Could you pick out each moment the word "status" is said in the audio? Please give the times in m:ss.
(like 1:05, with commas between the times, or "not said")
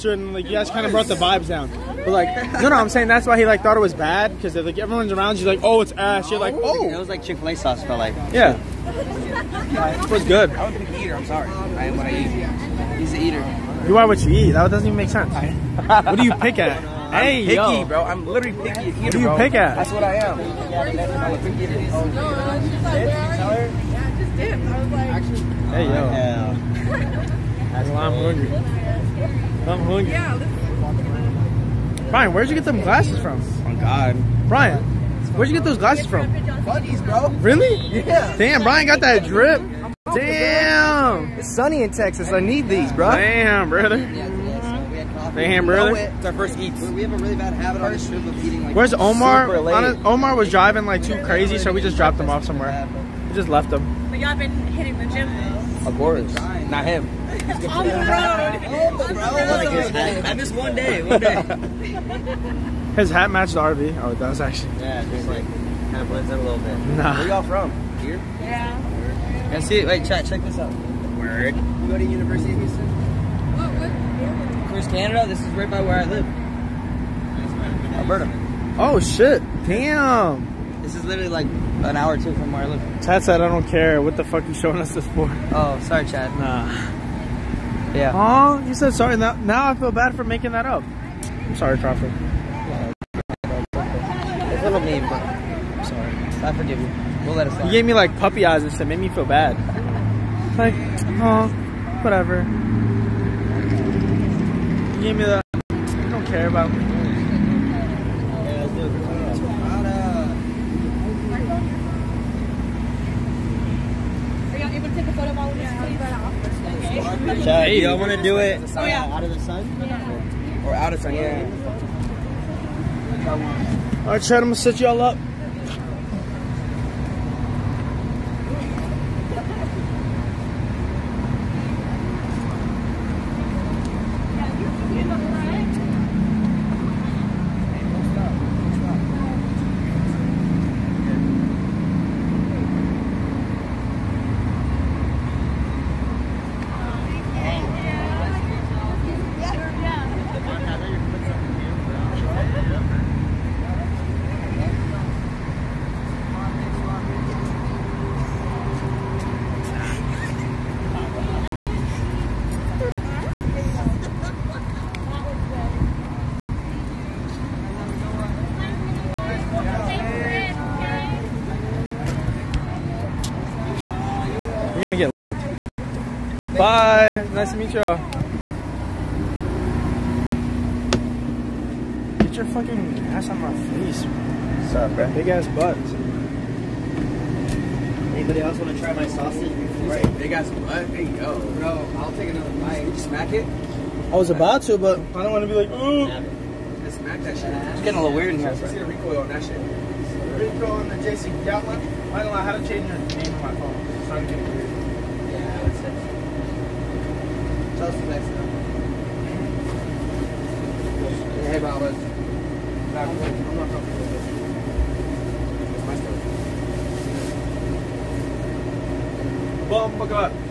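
not said.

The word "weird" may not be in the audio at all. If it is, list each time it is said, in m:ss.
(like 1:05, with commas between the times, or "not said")
3:18, 3:24.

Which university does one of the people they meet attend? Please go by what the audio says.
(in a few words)
University of Houston.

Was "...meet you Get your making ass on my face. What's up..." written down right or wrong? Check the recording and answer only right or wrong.
wrong.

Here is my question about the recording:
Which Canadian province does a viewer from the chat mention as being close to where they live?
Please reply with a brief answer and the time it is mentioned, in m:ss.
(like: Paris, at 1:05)
Alberta, at 1:17.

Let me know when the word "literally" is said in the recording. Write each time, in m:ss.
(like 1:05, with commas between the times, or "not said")
0:18, 1:21.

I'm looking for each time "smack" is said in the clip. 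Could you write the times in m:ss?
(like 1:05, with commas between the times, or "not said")
3:12, 3:16.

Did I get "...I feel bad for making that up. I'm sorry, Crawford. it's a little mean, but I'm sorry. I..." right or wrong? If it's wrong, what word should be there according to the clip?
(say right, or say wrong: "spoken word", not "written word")
right.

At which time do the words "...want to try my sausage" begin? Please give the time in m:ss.
3:08.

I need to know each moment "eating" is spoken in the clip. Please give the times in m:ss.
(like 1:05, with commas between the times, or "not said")
0:48.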